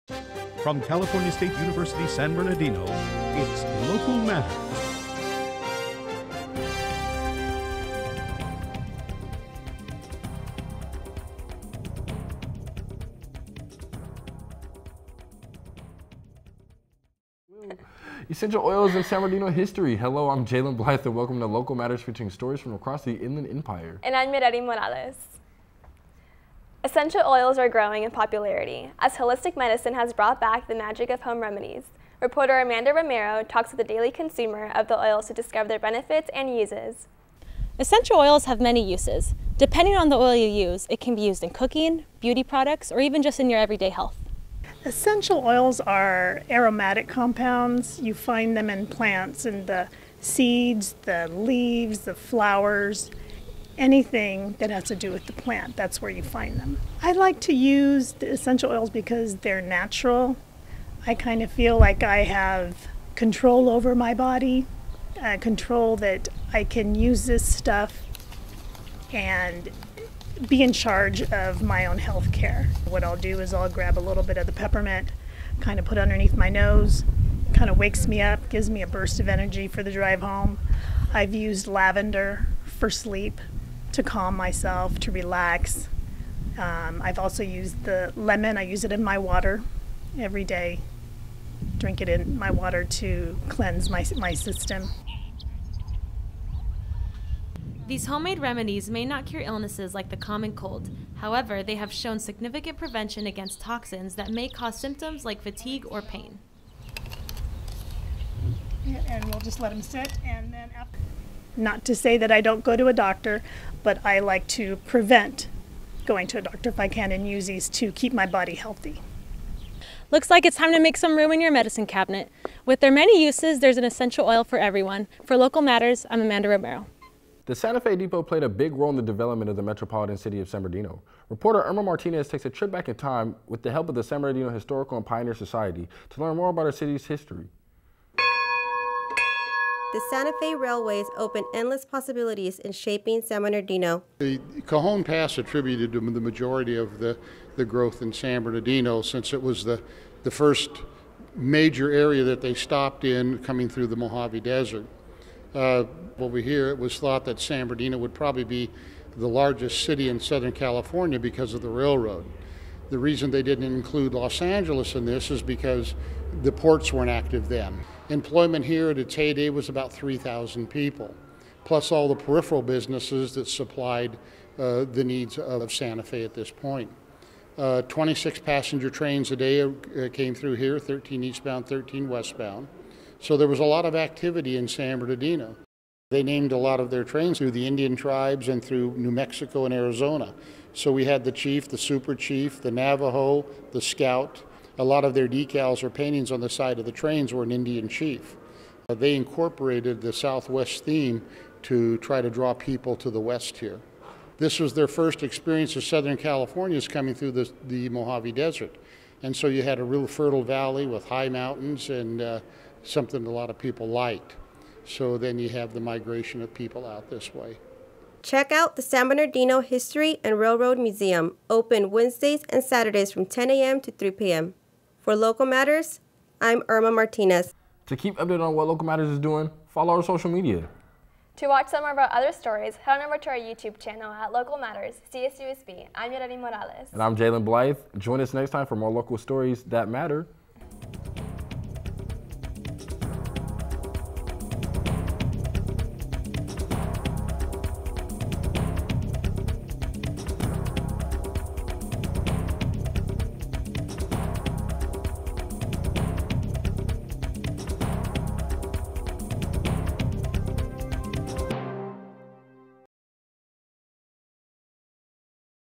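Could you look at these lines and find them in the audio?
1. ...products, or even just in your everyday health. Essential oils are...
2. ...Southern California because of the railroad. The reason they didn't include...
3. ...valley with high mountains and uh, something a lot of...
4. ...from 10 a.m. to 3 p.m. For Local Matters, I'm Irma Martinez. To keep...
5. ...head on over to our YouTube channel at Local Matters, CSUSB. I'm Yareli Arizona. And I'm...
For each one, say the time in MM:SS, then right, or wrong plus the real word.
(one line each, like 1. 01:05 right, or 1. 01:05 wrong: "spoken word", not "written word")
1. 00:42 right
2. 02:40 right
3. 03:30 right
4. 03:43 right
5. 03:52 wrong: "Morales", not "Arizona".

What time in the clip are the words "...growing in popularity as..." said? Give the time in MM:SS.
00:27.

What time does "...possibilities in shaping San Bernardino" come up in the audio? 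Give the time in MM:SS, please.
02:21.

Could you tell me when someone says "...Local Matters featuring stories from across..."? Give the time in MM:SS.
00:21.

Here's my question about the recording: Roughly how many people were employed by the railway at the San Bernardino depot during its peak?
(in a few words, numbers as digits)
3,000.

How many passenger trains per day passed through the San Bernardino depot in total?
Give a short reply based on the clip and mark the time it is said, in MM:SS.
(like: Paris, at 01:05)
26, at 02:57.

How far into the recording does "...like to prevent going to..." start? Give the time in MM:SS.
01:54.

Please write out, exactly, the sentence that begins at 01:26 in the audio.
Um, I've also used the lemon, I use it in my water every day.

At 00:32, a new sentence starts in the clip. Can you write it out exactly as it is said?
Reporter Amanda Romero talks with the daily consumer of the oils to discover their benefits and uses.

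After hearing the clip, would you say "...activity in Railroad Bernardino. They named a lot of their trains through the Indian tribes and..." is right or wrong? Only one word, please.
wrong.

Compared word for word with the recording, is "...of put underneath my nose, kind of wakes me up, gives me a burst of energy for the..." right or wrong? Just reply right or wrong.
right.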